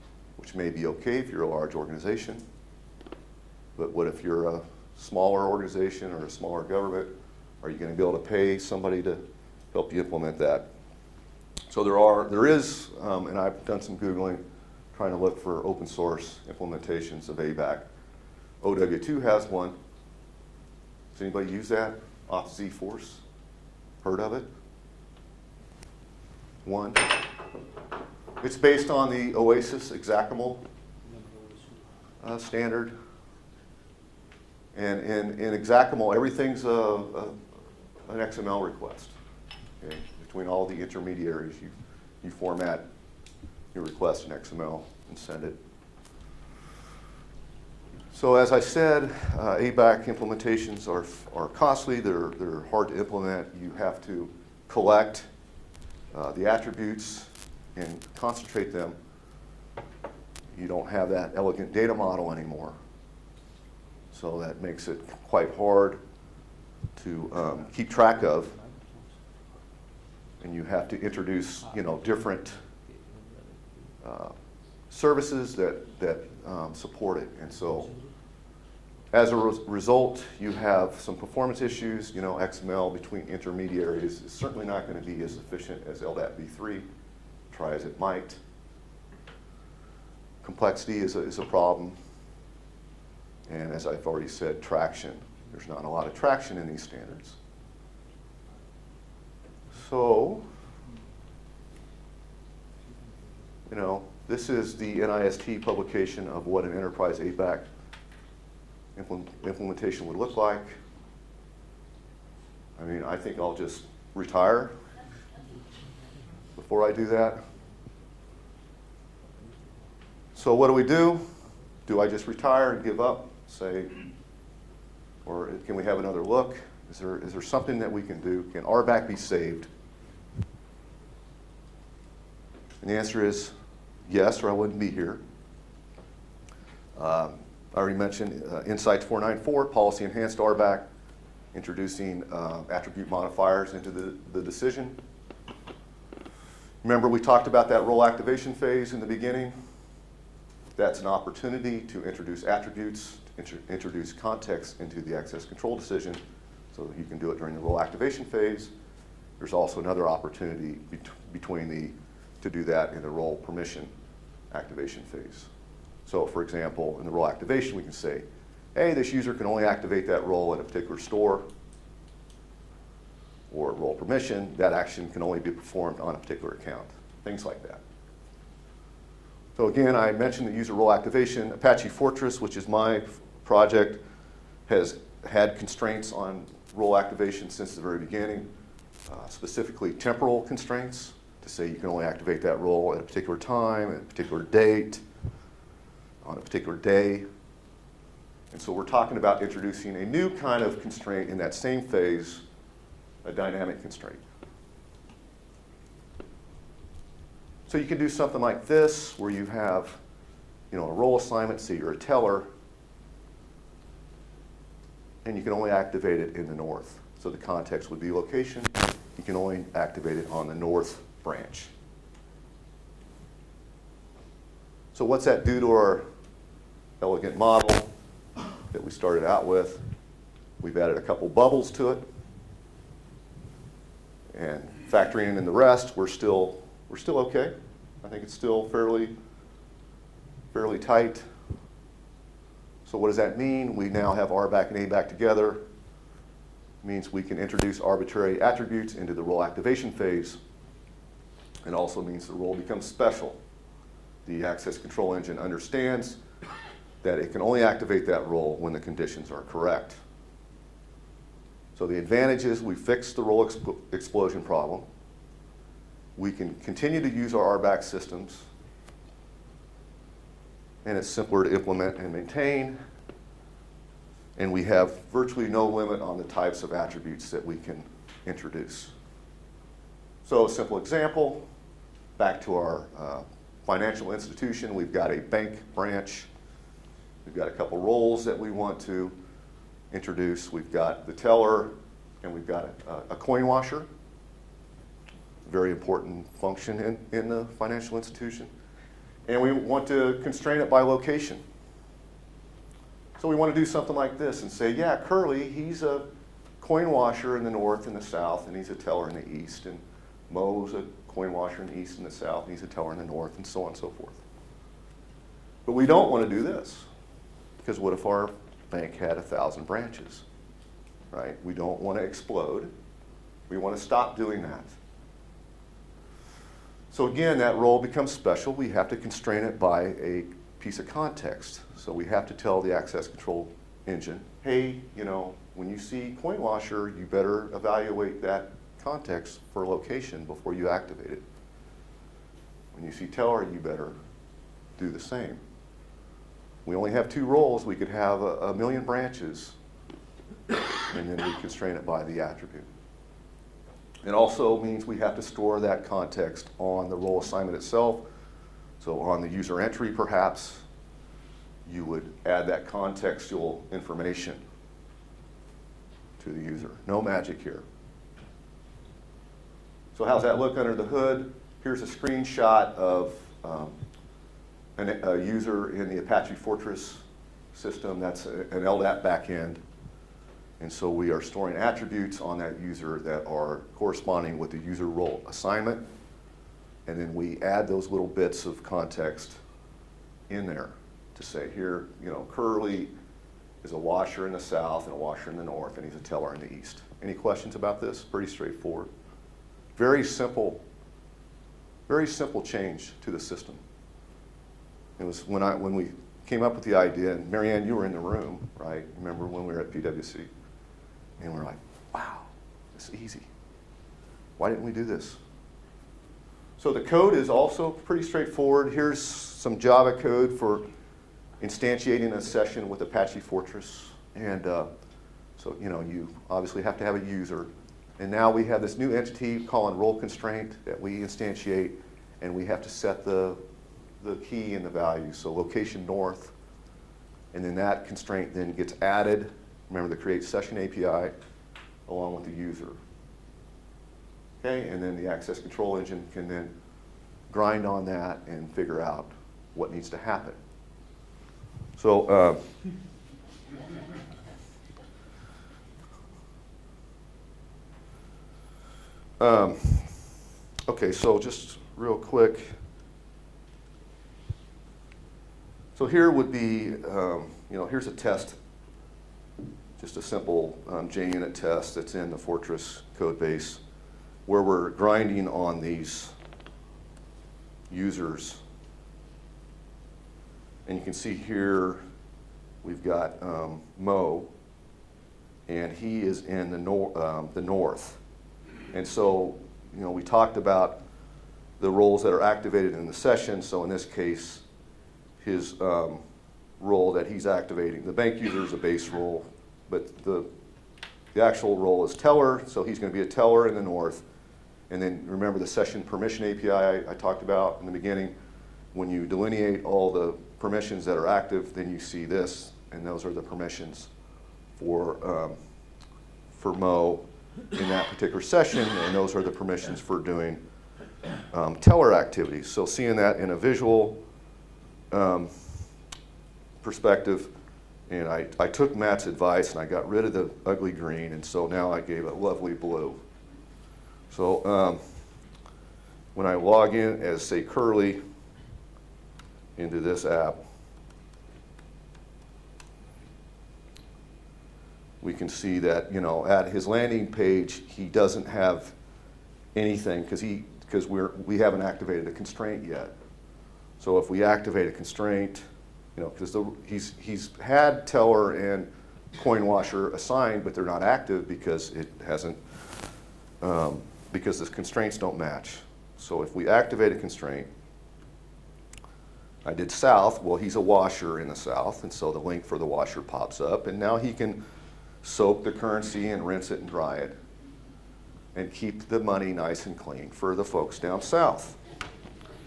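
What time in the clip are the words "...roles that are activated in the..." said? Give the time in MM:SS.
08:11.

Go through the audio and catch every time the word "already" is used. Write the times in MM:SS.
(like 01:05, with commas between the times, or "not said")
01:34, 02:17.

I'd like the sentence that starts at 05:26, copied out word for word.
So again, that role becomes special.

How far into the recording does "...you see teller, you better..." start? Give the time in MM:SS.
05:42.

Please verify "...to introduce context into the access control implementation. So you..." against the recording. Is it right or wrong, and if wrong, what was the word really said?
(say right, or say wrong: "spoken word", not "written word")
wrong: "decision", not "implementation".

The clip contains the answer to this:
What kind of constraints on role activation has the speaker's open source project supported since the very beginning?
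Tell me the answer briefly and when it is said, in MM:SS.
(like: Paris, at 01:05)
Temporal constraints, at 03:09.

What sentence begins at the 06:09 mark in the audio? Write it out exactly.
So how's that look under the hood?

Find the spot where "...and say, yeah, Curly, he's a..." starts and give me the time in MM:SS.
05:04.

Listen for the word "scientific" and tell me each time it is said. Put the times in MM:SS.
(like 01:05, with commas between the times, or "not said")
not said.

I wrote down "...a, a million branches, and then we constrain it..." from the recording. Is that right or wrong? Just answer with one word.
right.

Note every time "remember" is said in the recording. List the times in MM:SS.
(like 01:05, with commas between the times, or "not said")
02:26, 06:48, 07:19, 08:25.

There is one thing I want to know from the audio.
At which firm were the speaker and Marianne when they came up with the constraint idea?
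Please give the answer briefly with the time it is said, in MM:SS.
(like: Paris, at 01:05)
PwC, at 06:49.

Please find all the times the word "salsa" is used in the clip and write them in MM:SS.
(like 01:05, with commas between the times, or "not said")
not said.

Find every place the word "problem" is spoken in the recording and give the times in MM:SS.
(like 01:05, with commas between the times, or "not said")
01:31, 04:24.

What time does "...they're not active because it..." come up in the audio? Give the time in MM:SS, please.
09:20.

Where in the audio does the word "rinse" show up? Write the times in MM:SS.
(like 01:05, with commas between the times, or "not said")
09:36.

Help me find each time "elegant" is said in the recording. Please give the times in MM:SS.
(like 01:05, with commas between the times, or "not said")
01:01, 03:47.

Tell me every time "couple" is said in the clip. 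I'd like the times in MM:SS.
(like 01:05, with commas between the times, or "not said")
03:51, 04:47.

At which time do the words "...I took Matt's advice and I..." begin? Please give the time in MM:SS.
08:48.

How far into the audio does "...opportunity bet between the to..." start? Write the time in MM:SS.
02:40.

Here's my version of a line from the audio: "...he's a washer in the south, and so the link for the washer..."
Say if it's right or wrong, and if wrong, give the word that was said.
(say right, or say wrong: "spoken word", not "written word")
right.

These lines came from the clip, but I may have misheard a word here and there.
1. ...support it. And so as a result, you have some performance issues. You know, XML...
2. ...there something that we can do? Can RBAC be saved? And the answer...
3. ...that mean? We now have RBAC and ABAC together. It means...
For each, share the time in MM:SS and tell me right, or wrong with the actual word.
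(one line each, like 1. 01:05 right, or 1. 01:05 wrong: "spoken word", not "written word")
1. 01:16 right
2. 02:07 right
3. 04:03 right.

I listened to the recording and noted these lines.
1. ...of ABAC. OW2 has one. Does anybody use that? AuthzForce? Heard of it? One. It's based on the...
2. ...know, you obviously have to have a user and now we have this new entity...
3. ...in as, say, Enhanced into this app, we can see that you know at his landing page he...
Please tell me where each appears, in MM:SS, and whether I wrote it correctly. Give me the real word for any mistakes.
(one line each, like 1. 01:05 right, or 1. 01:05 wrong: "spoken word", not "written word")
1. 00:17 right
2. 07:05 right
3. 08:56 wrong: "Curly", not "Enhanced".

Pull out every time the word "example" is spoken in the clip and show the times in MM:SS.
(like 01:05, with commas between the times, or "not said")
02:46, 04:40.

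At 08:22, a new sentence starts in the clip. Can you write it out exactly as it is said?
So he's going to be a teller in the north.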